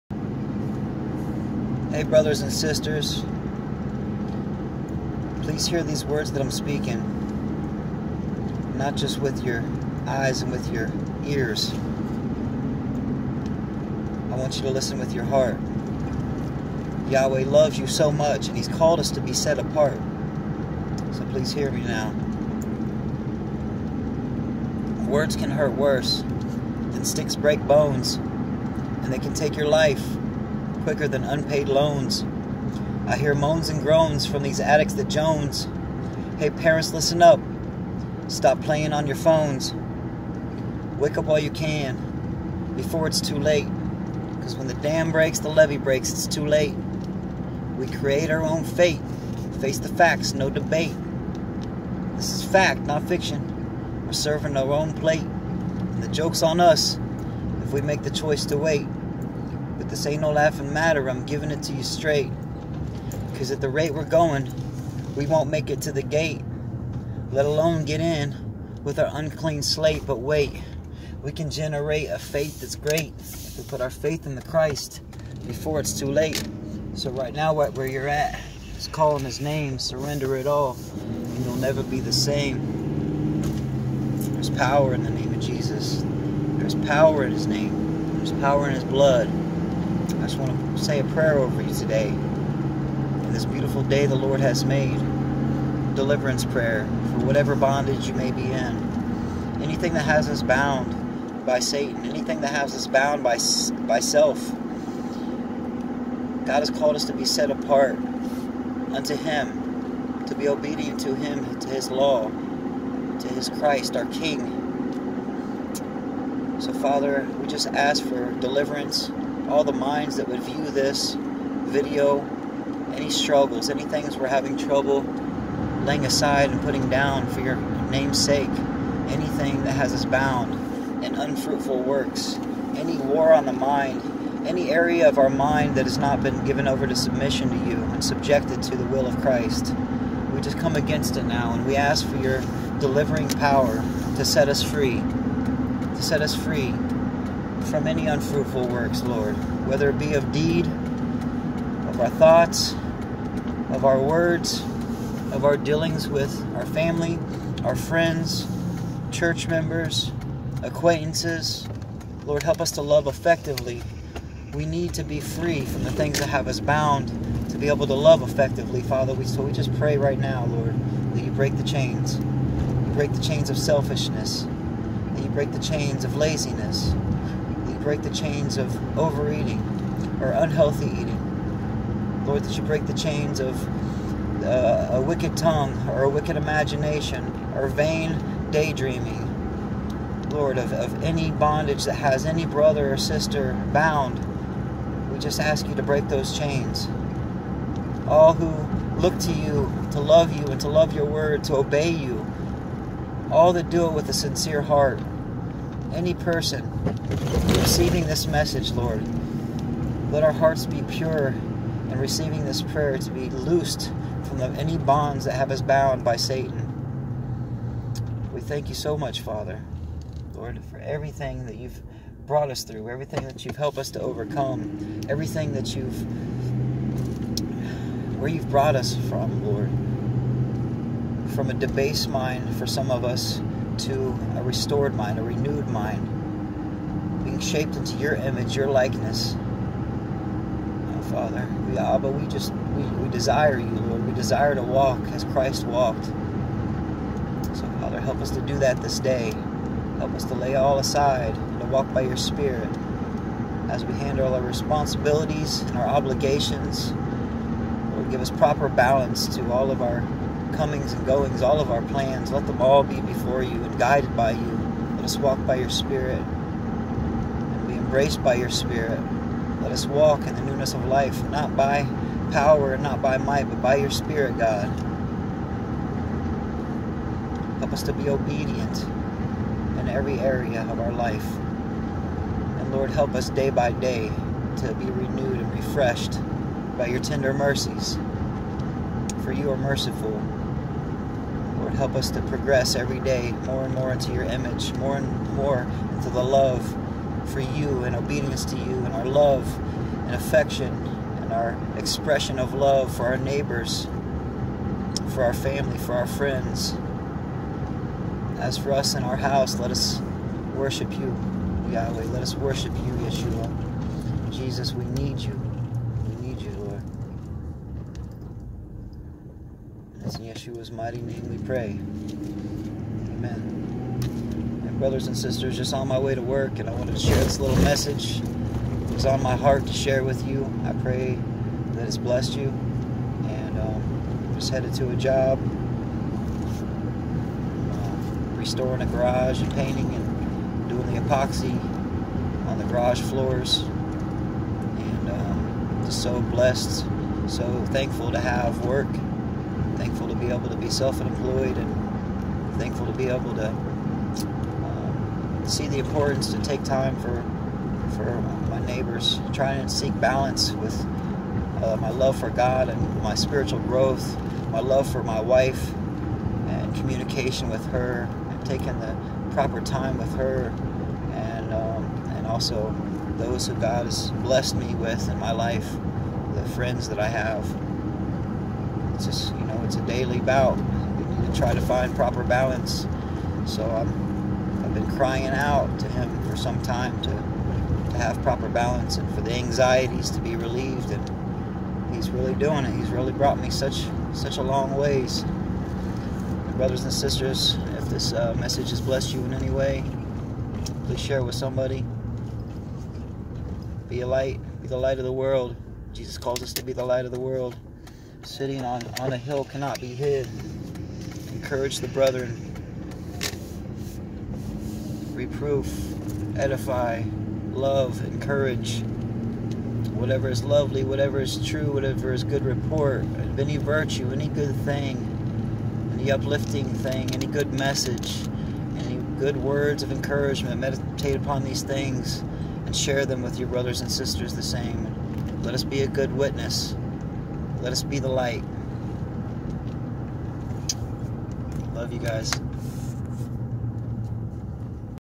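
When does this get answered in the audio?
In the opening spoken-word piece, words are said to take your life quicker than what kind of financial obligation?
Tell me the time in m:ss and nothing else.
0:31.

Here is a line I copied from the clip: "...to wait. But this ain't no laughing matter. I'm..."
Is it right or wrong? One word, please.
right.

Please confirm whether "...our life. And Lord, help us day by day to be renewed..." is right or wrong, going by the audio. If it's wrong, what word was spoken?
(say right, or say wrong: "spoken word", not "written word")
right.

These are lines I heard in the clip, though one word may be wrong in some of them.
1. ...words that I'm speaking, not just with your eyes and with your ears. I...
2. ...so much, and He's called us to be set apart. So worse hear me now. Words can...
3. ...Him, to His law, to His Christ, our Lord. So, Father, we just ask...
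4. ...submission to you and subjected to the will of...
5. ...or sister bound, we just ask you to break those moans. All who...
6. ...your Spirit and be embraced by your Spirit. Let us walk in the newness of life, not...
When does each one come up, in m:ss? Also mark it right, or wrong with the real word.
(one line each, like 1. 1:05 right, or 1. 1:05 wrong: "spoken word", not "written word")
1. 0:06 right
2. 0:17 wrong: "please", not "worse"
3. 1:51 wrong: "King", not "Lord"
4. 2:16 right
5. 3:12 wrong: "chains", not "moans"
6. 4:25 right.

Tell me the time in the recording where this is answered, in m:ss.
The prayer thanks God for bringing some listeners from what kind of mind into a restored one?
3:51.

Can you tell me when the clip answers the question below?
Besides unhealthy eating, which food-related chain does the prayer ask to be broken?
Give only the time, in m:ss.
2:58.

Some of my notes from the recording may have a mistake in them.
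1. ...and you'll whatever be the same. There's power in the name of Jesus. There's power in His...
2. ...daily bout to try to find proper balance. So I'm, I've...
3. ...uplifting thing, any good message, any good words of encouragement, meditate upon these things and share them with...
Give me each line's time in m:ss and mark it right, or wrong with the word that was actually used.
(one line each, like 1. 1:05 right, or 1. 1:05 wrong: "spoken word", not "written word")
1. 1:21 wrong: "never", not "whatever"
2. 6:19 right
3. 7:06 right.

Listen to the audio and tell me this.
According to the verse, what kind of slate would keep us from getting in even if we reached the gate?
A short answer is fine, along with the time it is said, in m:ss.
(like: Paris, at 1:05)
unclean slate, at 1:09.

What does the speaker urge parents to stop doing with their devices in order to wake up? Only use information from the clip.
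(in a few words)
playing on your phones.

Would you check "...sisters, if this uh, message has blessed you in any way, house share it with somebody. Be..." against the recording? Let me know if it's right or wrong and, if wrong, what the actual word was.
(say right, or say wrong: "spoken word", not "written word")
wrong: "please", not "house".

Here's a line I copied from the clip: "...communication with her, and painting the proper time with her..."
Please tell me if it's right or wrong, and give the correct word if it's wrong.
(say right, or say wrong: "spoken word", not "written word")
wrong: "taking", not "painting".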